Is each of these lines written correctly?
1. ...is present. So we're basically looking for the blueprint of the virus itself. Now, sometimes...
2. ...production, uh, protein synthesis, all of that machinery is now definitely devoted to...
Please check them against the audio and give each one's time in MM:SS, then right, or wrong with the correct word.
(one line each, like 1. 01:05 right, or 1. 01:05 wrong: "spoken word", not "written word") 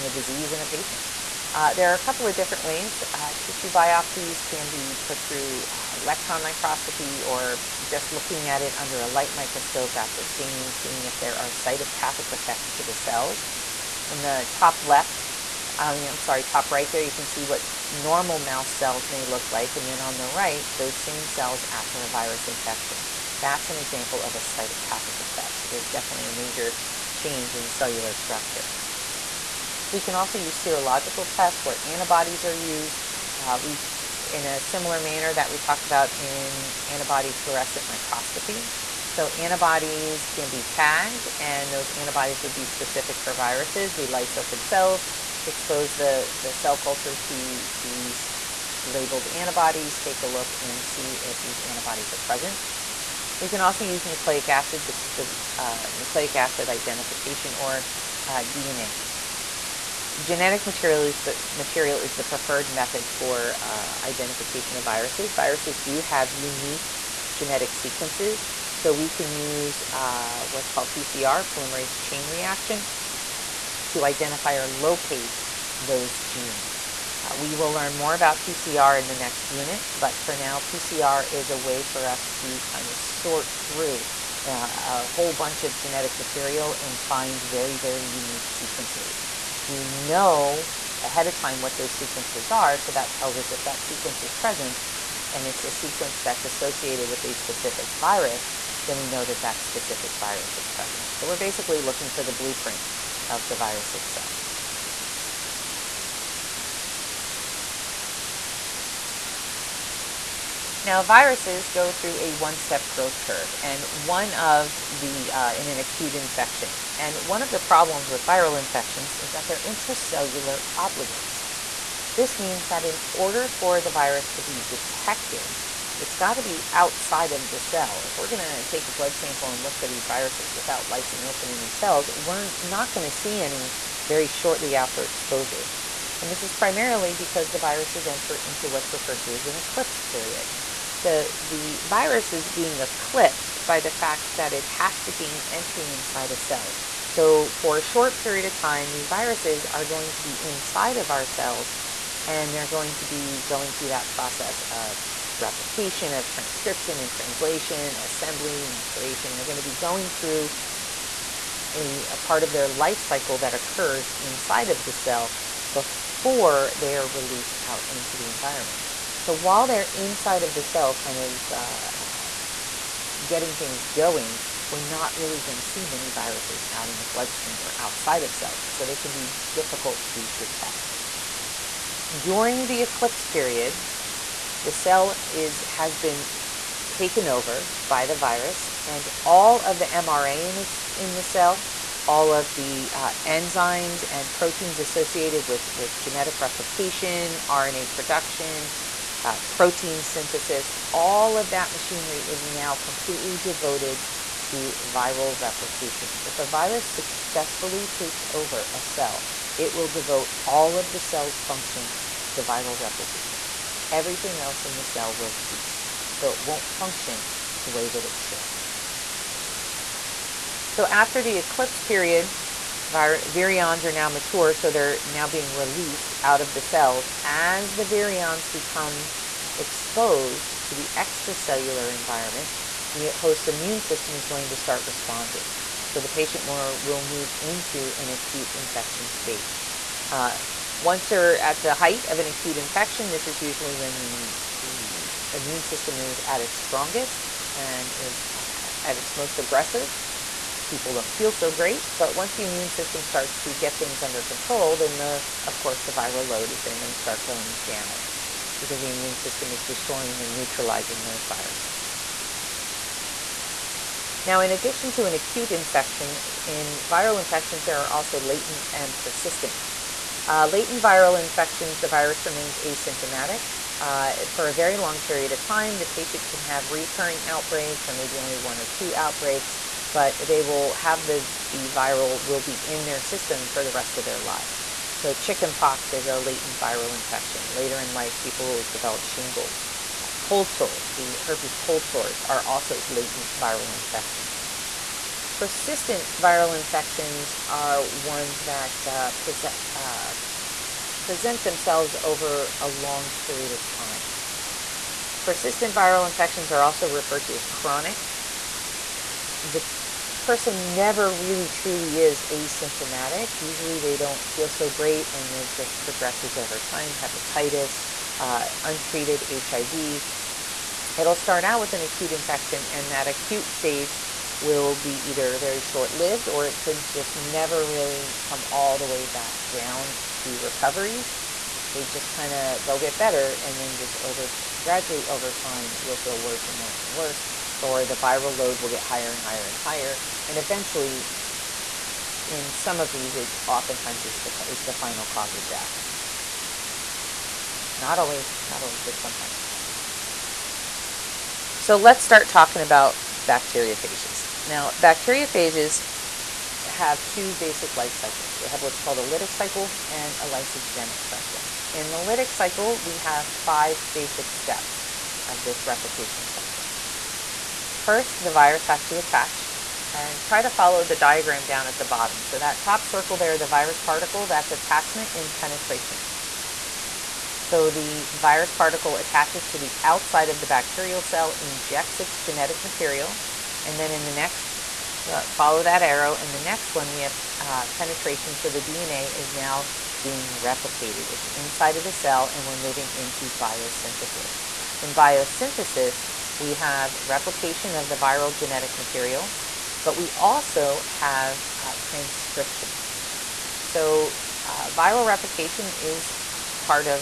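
1. 01:40 wrong: "viruses", not "sometimes"
2. 03:17 wrong: "completely", not "definitely".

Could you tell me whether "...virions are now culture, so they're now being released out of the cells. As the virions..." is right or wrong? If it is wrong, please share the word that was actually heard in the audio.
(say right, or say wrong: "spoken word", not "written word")
wrong: "mature", not "culture".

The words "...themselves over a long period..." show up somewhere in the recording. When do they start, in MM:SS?
05:01.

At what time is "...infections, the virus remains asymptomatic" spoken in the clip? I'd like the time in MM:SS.
04:31.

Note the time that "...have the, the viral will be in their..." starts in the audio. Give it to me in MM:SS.
04:40.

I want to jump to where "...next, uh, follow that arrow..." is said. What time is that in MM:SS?
06:24.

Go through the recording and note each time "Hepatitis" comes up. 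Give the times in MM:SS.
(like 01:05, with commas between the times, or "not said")
05:16.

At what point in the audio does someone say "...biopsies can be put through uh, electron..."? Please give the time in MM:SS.
00:03.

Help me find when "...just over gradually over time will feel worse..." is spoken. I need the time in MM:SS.
05:33.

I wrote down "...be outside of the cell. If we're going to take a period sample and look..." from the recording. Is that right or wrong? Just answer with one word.
wrong.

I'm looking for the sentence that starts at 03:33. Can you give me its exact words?
Everything else in the cell will cease, so it won't function the way that it should.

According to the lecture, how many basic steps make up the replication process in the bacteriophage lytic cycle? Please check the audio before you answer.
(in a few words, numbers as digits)
5.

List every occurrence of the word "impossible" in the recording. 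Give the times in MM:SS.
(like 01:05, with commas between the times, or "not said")
not said.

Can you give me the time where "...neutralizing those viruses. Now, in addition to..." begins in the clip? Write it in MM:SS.
04:20.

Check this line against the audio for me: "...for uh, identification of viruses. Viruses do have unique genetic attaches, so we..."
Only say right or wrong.
wrong.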